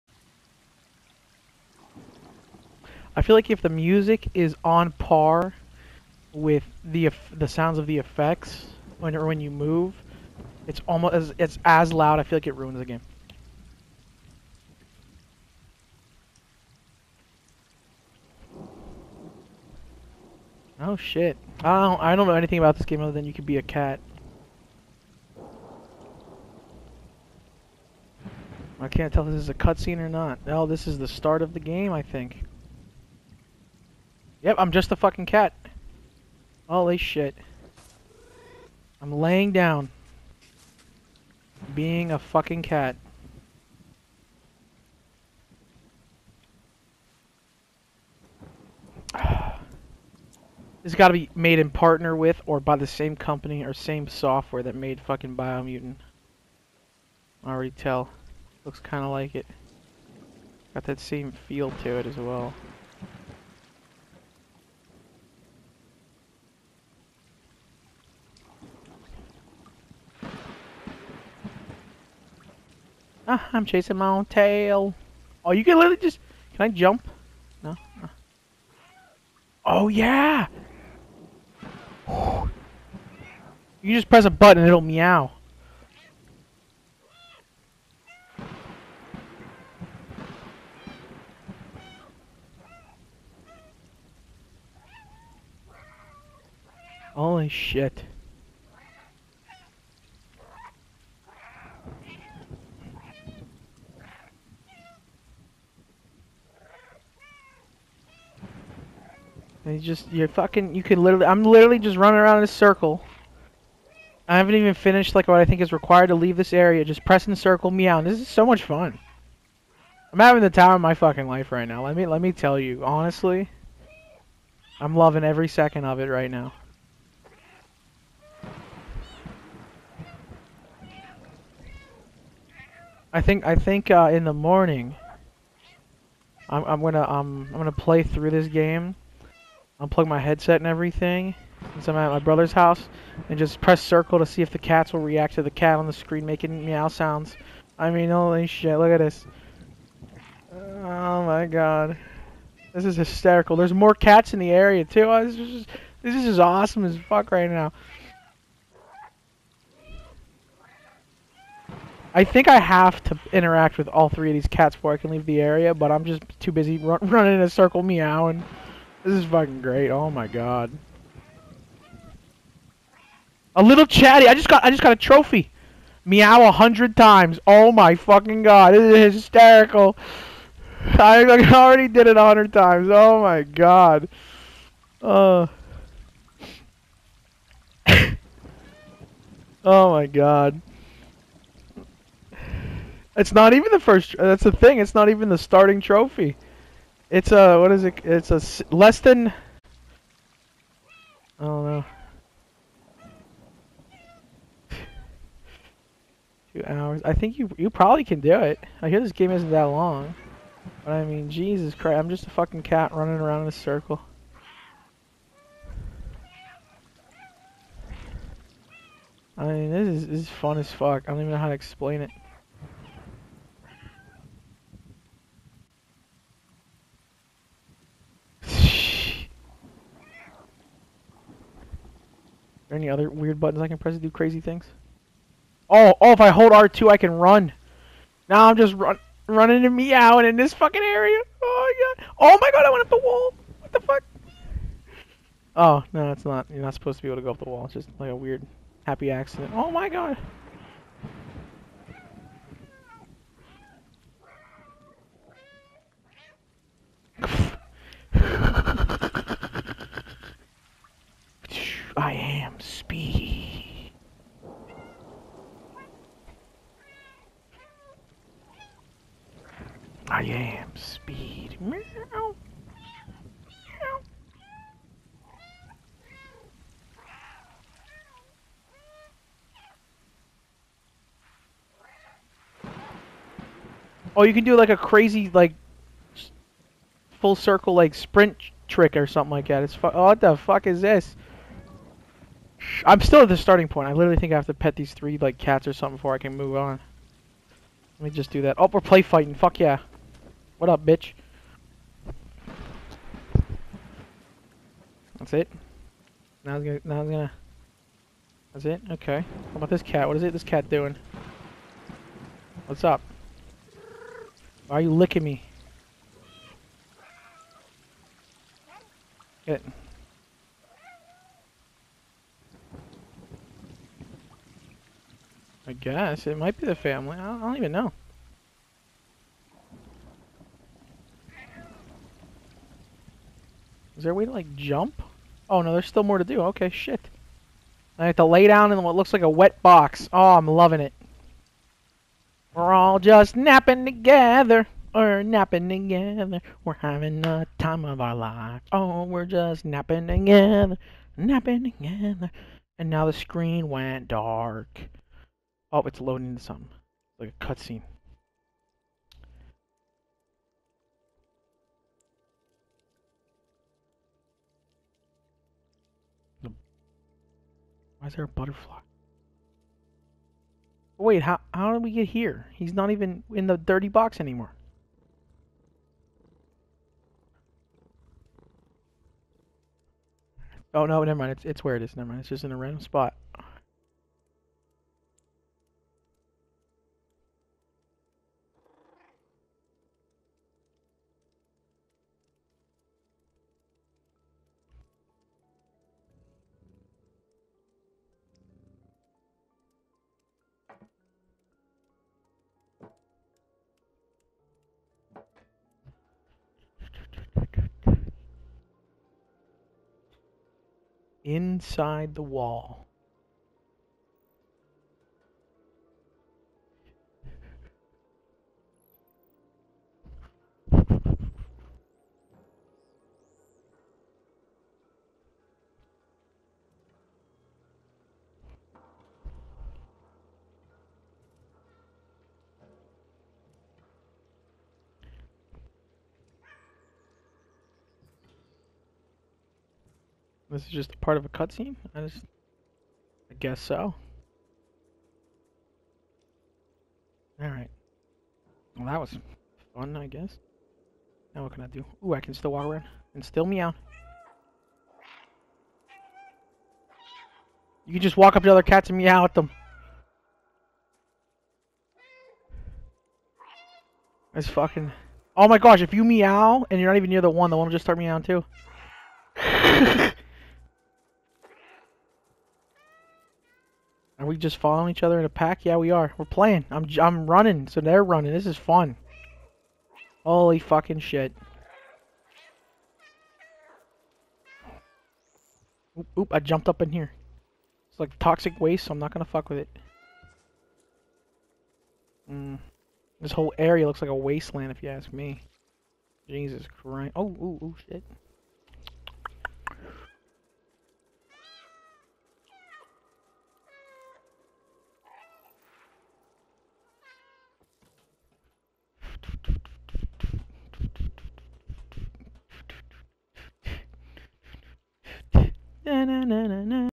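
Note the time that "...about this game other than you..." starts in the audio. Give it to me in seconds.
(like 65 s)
22 s.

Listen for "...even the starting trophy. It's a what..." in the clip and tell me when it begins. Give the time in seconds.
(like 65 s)
195 s.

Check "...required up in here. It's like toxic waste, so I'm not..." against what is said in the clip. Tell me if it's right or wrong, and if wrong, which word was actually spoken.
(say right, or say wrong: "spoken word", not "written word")
wrong: "jumped", not "required".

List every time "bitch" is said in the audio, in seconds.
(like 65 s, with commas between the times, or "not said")
300 s.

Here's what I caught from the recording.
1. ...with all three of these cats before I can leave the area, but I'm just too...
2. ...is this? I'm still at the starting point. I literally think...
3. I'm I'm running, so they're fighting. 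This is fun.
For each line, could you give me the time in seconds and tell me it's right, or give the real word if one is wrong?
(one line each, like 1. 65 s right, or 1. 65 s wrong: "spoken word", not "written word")
1. 163 s right
2. 290 s right
3. 476 s wrong: "running", not "fighting".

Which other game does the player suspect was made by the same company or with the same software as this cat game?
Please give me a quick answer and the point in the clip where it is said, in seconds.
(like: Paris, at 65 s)
Biomutant, at 55 s.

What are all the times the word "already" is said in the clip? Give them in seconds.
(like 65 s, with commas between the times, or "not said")
57 s, 181 s.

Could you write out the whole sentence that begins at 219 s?
I mean, this is this is fun as fuck.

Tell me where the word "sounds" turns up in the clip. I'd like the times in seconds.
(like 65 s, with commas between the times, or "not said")
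7 s, 146 s.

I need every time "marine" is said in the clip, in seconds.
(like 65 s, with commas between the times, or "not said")
not said.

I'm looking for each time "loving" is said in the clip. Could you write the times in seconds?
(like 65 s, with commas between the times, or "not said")
124 s, 340 s.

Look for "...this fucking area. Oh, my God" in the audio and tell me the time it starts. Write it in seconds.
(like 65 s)
240 s.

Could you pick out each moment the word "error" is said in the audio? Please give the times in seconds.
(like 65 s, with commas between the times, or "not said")
not said.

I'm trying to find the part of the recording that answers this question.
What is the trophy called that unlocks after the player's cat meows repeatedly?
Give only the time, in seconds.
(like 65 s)
173 s.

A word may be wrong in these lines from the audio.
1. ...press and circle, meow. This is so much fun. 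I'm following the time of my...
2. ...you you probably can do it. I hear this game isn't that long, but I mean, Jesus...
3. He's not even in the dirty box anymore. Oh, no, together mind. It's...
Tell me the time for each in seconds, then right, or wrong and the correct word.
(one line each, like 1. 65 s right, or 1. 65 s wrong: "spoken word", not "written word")
1. 117 s wrong: "having", not "following"
2. 207 s right
3. 372 s wrong: "never", not "together".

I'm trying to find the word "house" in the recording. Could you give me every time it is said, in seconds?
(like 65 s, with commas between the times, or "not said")
142 s.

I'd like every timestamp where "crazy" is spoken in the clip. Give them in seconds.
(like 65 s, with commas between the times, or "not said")
234 s, 284 s.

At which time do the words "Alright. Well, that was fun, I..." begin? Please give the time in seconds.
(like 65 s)
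447 s.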